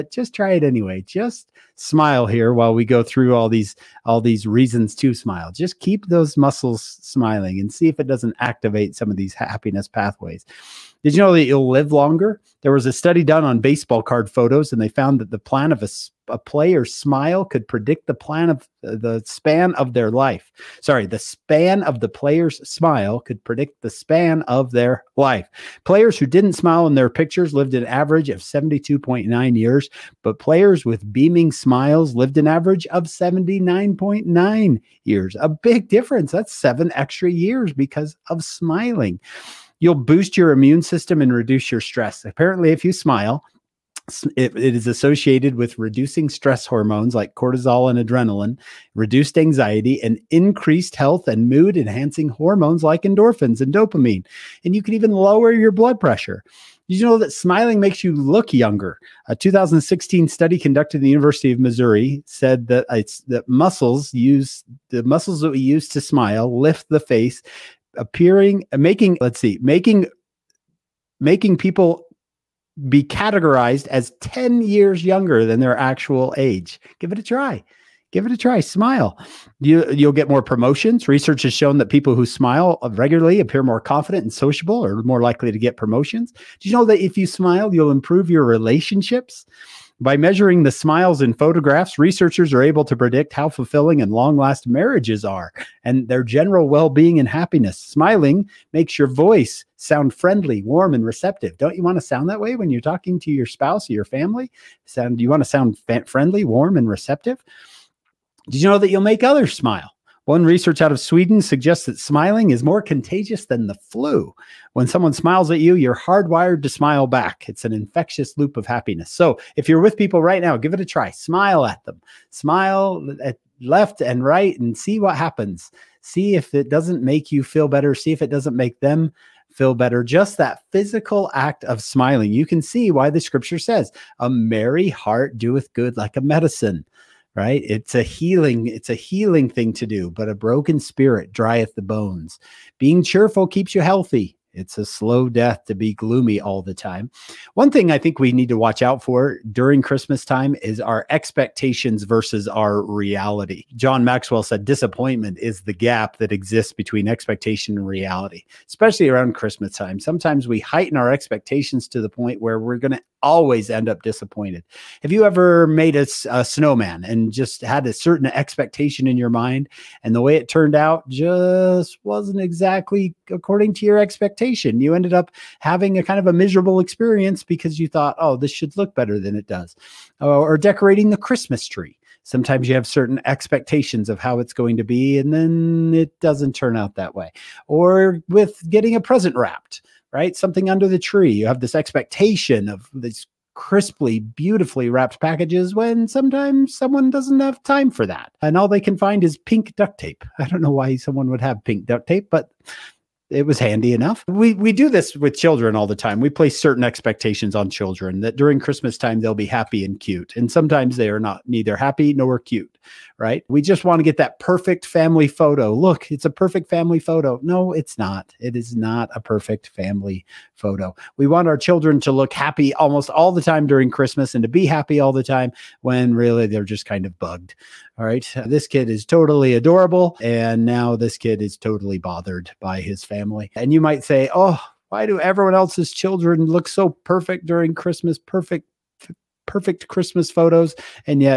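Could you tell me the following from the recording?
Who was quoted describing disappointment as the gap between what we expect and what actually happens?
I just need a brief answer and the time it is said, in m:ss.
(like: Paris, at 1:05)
John Maxwell, at 2:33.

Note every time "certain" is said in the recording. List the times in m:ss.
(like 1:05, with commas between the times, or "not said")
2:47, 3:02, 3:26.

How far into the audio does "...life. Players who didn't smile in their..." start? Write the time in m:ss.
0:25.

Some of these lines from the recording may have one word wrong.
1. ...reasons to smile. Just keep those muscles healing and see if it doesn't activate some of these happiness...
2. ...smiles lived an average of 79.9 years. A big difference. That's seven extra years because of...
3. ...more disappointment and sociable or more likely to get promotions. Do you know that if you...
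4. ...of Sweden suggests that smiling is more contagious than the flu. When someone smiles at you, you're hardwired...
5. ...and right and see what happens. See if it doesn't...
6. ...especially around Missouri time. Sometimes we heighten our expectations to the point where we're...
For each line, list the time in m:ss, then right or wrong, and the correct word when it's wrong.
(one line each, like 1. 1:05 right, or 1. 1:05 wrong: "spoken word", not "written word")
1. 0:04 wrong: "smiling", not "healing"
2. 0:31 right
3. 1:23 wrong: "confident", not "disappointment"
4. 1:50 right
5. 2:04 right
6. 2:38 wrong: "Christmas", not "Missouri".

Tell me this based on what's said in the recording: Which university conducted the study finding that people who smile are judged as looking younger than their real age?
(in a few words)
University of Missouri.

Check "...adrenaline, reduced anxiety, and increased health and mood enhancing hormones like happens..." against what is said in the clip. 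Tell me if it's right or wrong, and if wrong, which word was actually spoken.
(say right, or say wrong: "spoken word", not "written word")
wrong: "endorphins", not "happens".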